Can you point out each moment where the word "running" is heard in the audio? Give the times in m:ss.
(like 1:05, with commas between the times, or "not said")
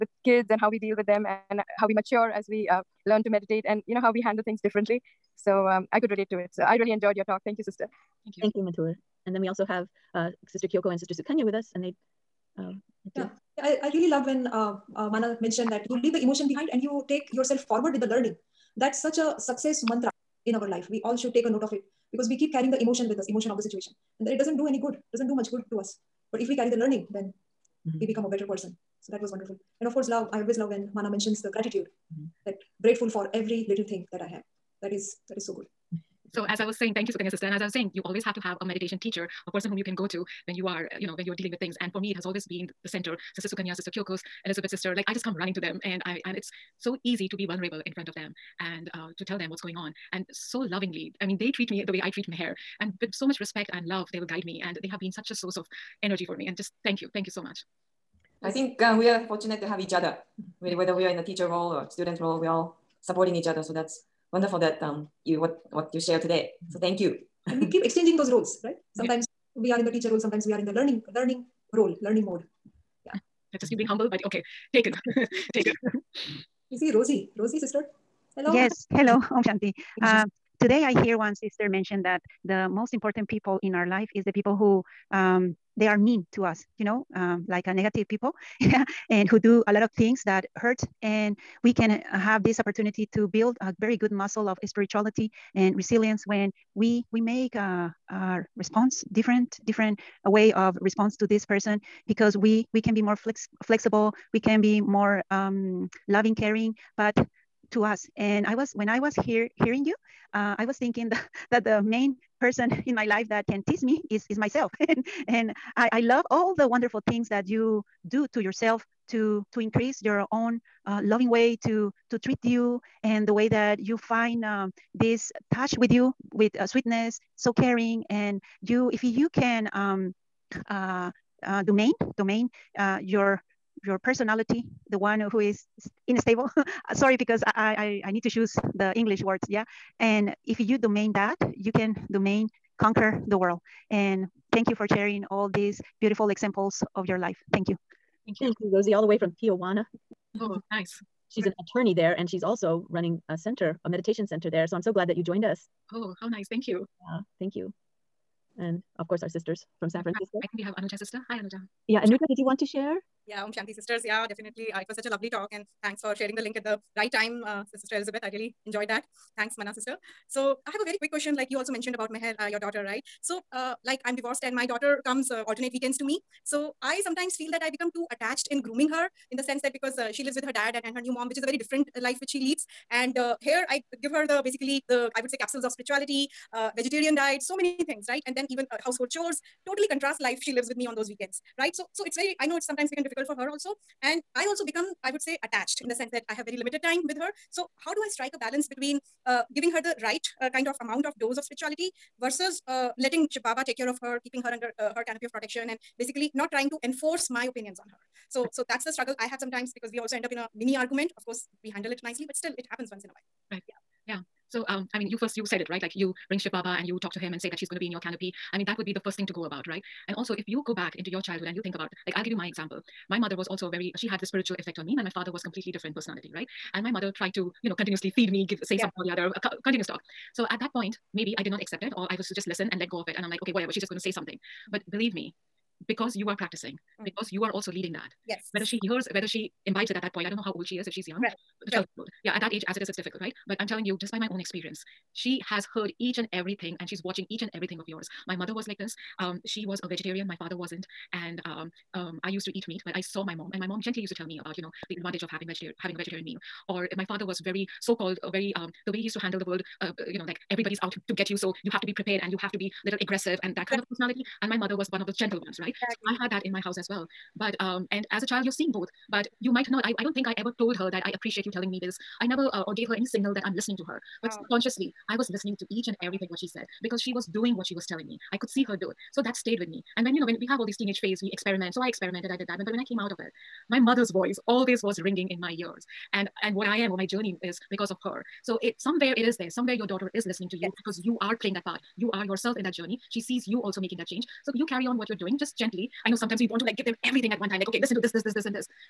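0:45, 2:32.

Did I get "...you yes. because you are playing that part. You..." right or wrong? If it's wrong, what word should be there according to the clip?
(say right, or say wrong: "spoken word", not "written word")
right.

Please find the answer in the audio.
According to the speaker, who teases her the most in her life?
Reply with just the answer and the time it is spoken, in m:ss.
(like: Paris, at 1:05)
myself, at 1:54.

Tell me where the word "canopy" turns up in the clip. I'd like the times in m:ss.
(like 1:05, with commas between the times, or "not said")
3:25, 3:37.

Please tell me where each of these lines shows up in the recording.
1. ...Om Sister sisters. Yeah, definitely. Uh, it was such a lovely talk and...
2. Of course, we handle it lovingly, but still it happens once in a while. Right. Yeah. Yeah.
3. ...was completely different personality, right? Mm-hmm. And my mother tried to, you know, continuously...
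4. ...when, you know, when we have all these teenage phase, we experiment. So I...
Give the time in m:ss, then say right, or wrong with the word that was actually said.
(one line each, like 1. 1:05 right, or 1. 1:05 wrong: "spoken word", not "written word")
1. 2:43 wrong: "Shanti", not "Sister"
2. 3:31 wrong: "nicely", not "lovingly"
3. 3:45 right
4. 4:40 right.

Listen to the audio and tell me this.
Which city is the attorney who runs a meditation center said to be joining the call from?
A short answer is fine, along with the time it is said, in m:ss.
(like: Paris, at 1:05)
Tijuana, at 2:29.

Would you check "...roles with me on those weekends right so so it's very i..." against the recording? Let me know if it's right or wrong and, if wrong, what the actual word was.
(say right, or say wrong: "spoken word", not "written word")
wrong: "lives", not "roles".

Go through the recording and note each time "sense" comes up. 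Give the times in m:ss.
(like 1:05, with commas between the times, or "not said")
2:59, 3:15.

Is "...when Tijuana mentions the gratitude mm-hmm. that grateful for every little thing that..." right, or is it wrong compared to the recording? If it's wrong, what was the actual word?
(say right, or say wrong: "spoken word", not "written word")
wrong: "Manna", not "Tijuana".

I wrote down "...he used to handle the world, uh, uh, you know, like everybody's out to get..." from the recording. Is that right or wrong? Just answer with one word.
right.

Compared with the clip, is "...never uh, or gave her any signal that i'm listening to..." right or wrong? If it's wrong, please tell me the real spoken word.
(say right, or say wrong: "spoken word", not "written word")
right.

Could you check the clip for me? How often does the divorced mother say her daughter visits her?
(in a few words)
alternate weekends.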